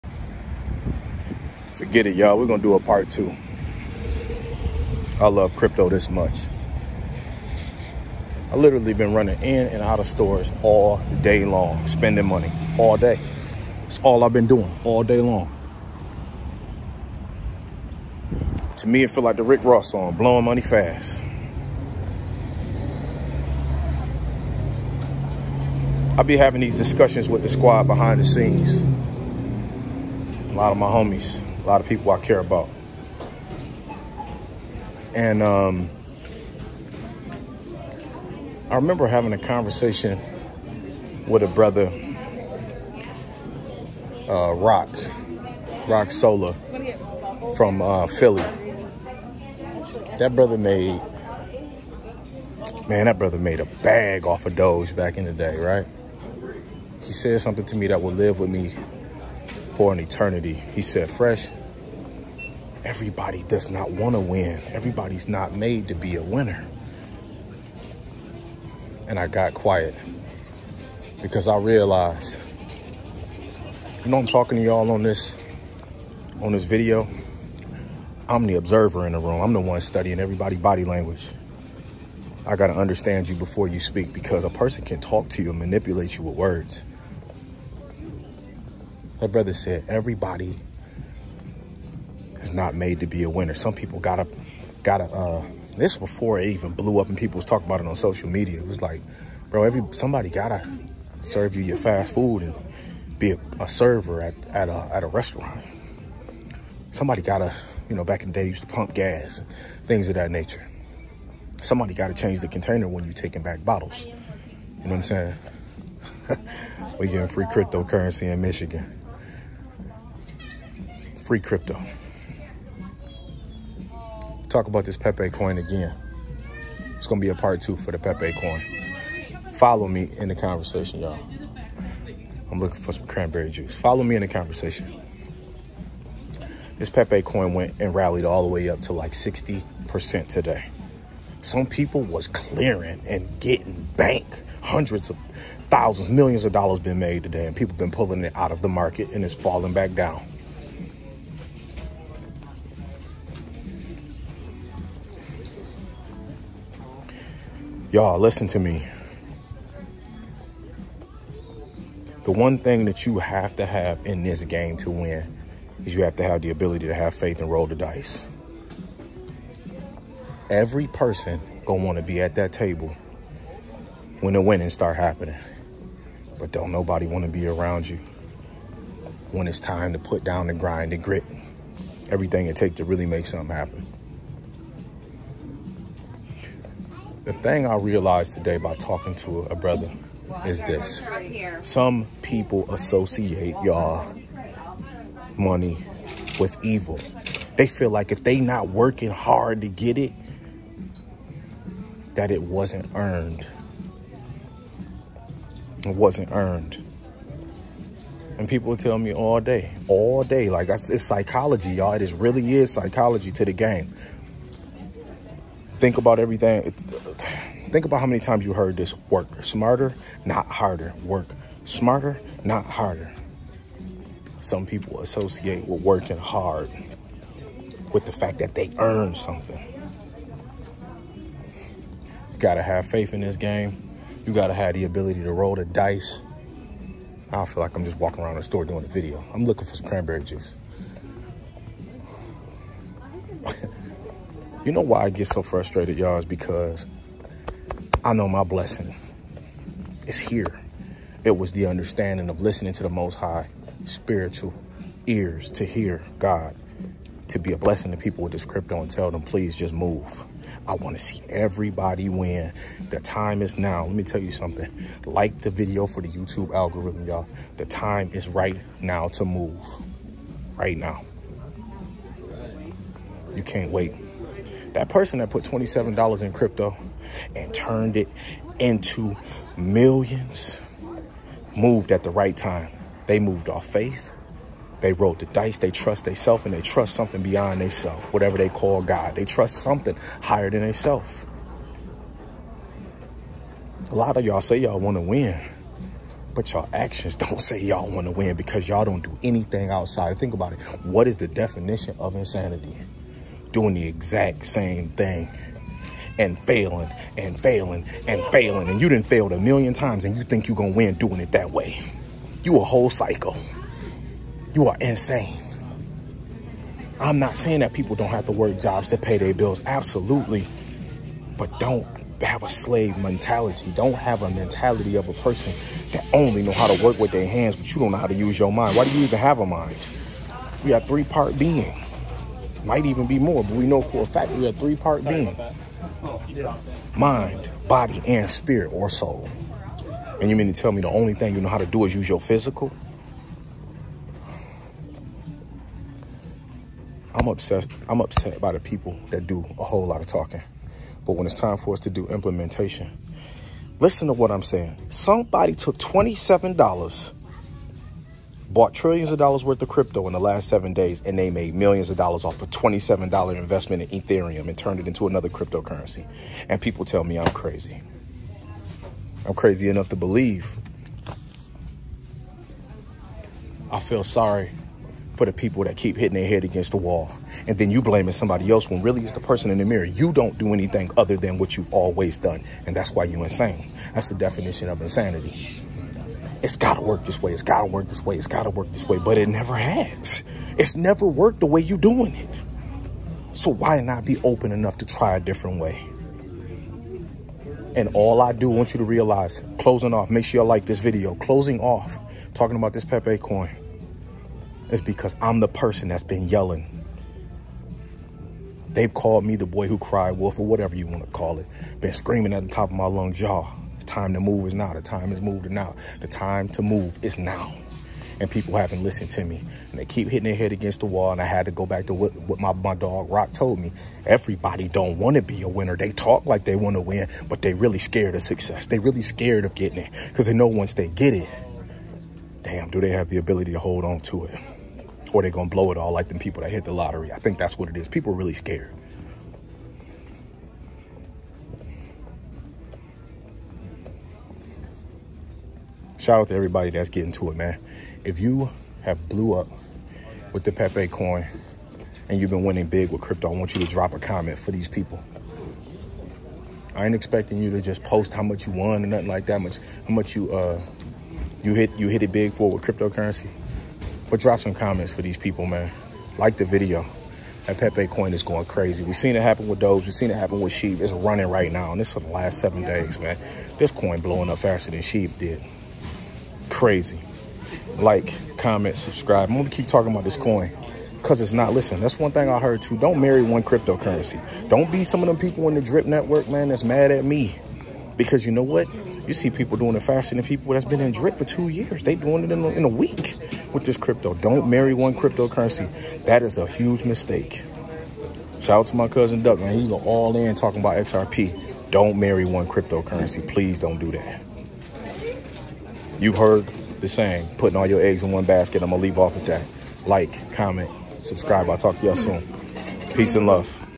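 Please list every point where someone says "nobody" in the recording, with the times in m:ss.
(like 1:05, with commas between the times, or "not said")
2:56.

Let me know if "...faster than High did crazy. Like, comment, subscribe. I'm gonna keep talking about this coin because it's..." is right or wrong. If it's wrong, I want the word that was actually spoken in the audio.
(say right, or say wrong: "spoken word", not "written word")
wrong: "Shib", not "High".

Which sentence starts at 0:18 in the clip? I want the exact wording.
To me, it feel like the Rick Ross song, blowing money fast.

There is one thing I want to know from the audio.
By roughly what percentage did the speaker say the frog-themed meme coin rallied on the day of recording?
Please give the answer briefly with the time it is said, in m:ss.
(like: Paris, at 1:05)
60%, at 2:19.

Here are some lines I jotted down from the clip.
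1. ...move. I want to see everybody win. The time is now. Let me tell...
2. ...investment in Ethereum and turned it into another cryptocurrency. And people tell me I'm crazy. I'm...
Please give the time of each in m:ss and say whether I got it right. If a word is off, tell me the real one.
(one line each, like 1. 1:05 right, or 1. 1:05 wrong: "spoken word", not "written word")
1. 4:19 right
2. 6:03 right.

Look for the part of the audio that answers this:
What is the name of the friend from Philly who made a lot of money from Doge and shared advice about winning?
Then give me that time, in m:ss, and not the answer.
0:45.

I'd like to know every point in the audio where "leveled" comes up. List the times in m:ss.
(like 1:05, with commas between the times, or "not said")
not said.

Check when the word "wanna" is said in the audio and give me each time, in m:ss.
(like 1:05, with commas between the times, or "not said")
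2:51, 2:57.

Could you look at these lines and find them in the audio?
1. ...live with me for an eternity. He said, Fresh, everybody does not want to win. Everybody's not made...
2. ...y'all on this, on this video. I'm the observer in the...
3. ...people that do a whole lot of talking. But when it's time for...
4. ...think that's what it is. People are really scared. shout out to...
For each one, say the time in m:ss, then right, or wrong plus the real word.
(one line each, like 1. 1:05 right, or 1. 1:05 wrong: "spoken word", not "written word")
1. 0:58 right
2. 1:14 right
3. 5:48 right
4. 7:17 right.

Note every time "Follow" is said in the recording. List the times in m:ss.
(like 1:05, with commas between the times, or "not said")
2:09, 2:13.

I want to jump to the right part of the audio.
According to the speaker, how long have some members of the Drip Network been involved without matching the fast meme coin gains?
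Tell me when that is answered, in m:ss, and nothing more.
8:11.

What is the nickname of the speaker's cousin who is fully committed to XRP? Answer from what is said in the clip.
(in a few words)
Duck.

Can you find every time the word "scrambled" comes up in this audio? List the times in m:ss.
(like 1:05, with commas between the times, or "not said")
not said.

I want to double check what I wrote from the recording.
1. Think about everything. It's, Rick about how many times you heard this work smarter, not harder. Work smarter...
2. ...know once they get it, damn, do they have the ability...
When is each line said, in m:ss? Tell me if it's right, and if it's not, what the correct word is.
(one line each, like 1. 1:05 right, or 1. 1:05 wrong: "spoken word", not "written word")
1. 3:35 wrong: "Think", not "Rick"
2. 7:10 right.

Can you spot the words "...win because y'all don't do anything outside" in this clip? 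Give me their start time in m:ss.
4:58.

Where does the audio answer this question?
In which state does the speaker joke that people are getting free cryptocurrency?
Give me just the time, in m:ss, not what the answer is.
1:58.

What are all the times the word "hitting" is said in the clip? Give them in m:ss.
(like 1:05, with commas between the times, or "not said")
6:15, 7:00.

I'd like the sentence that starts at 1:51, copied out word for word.
Somebody gotta change the container when you taking back bottles.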